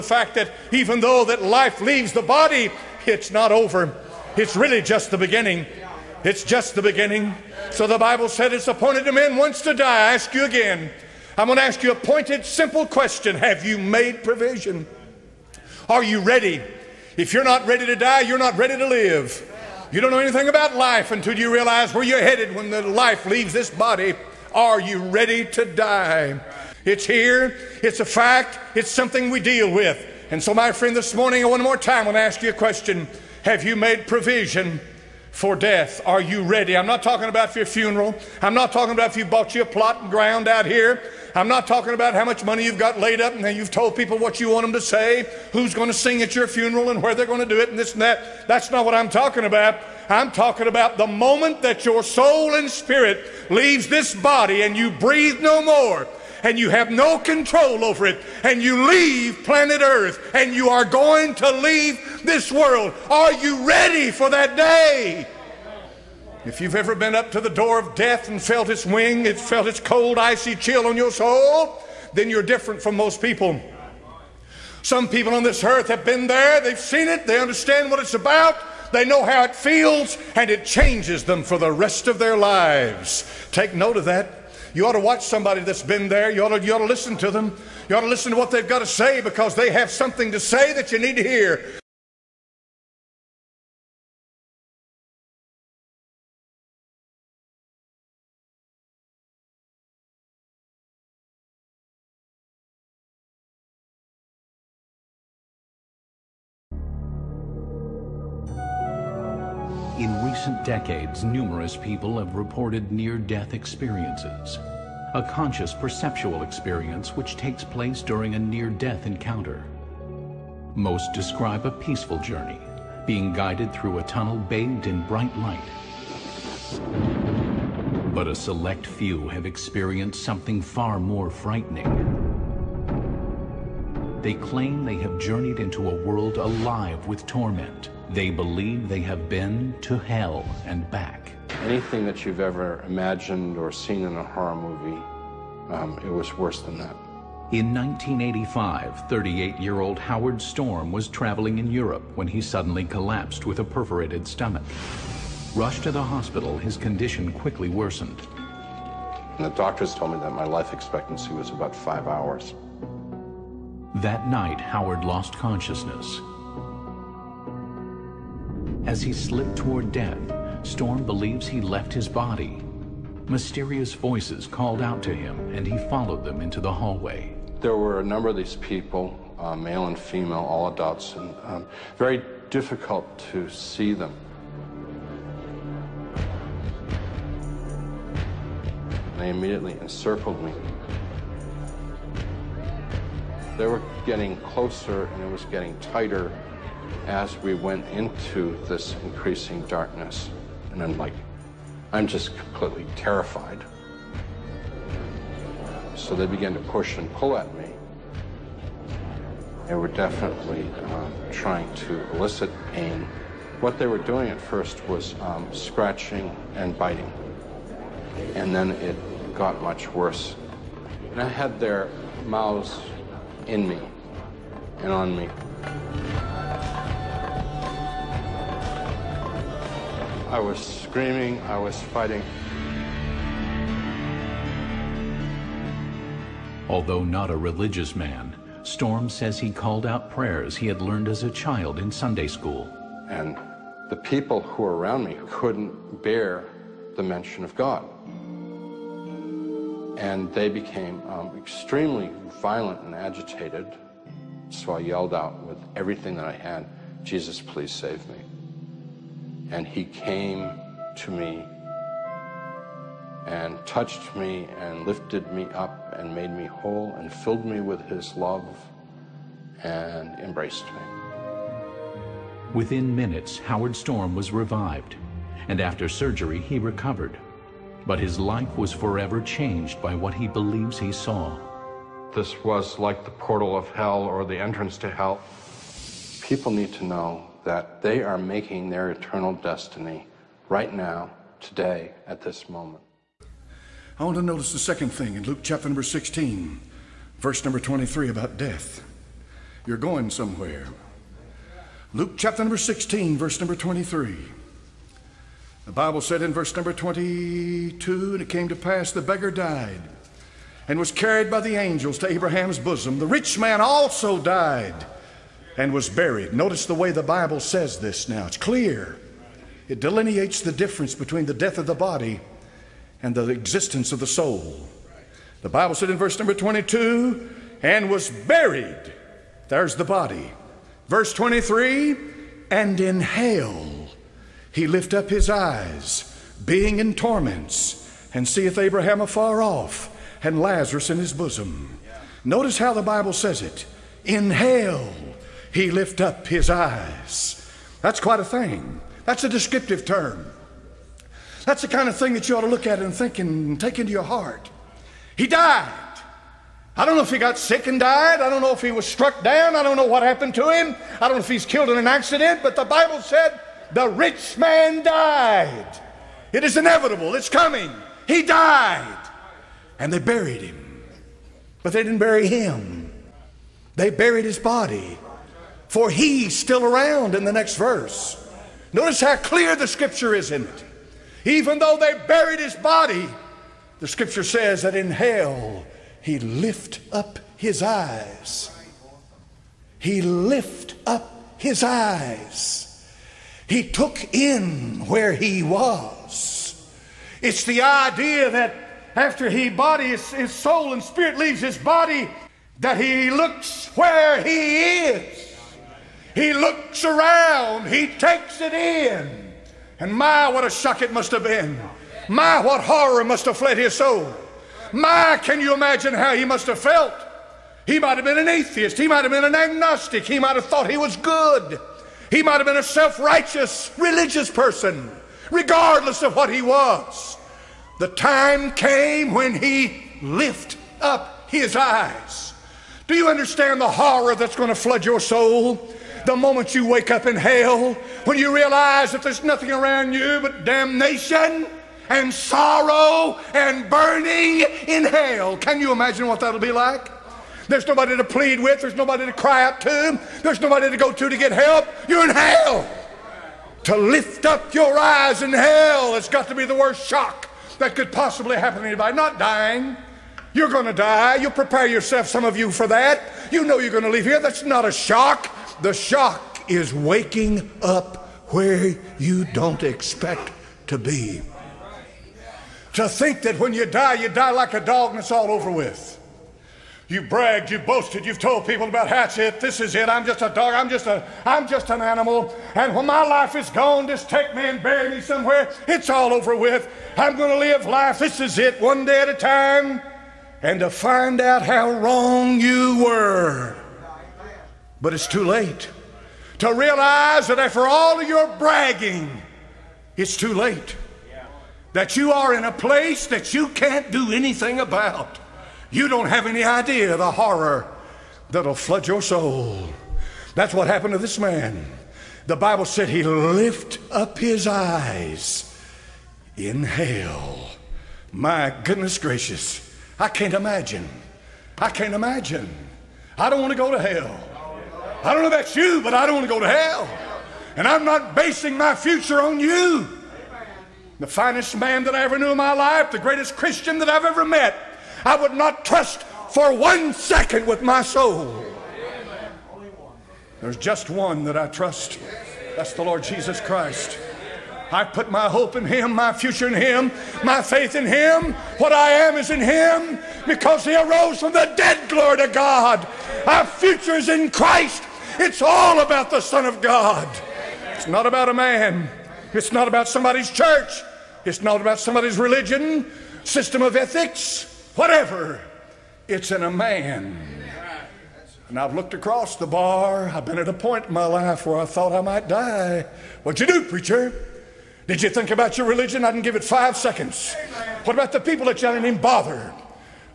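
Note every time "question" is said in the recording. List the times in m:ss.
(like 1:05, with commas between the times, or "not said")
0:12, 0:32.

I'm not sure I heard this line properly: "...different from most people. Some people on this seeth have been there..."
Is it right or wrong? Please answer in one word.
wrong.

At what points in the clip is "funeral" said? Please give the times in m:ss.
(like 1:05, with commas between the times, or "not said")
0:37, 0:46.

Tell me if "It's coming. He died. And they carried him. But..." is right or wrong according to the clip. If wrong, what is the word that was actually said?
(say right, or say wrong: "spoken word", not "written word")
wrong: "buried", not "carried".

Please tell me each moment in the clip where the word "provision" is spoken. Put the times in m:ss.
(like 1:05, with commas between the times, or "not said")
0:14, 0:34.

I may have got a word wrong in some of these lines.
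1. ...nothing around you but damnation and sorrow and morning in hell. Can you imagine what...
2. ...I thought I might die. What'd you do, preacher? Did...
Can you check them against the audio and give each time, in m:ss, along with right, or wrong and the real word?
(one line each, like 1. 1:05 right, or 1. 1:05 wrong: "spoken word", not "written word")
1. 7:19 wrong: "burning", not "morning"
2. 9:31 right.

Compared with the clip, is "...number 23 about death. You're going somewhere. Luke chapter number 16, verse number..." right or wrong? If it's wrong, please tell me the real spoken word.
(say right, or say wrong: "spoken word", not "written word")
right.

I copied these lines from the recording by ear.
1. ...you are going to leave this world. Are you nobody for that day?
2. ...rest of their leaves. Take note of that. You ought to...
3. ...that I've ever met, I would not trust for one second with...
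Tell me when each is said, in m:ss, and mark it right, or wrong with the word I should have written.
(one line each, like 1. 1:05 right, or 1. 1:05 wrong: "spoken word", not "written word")
1. 1:00 wrong: "ready", not "nobody"
2. 1:21 wrong: "lives", not "leaves"
3. 8:53 right.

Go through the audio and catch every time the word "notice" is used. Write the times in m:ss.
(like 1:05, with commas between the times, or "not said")
4:54, 5:16, 5:42, 6:18.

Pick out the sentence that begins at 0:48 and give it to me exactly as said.
That's not what I'm talking about.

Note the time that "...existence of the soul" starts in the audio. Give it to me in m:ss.
5:23.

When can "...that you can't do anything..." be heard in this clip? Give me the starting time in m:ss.
8:23.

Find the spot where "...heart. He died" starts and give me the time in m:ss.
5:54.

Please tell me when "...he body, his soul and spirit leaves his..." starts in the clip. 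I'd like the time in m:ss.
6:39.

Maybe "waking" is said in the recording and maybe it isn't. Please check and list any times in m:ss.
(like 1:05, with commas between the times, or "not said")
7:46.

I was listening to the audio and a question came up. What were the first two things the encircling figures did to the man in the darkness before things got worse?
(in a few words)
Scratching and biting.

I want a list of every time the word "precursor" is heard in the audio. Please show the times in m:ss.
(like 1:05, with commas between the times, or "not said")
not said.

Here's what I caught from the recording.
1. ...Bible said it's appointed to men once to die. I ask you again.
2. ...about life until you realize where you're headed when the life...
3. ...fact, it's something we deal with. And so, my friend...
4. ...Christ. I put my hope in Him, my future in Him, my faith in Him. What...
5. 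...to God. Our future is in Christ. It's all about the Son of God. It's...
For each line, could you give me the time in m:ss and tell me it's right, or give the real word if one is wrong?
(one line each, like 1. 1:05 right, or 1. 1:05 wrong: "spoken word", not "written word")
1. 0:07 right
2. 0:20 right
3. 0:28 right
4. 9:03 right
5. 9:12 right.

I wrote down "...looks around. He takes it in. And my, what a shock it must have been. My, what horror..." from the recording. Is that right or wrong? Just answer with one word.
right.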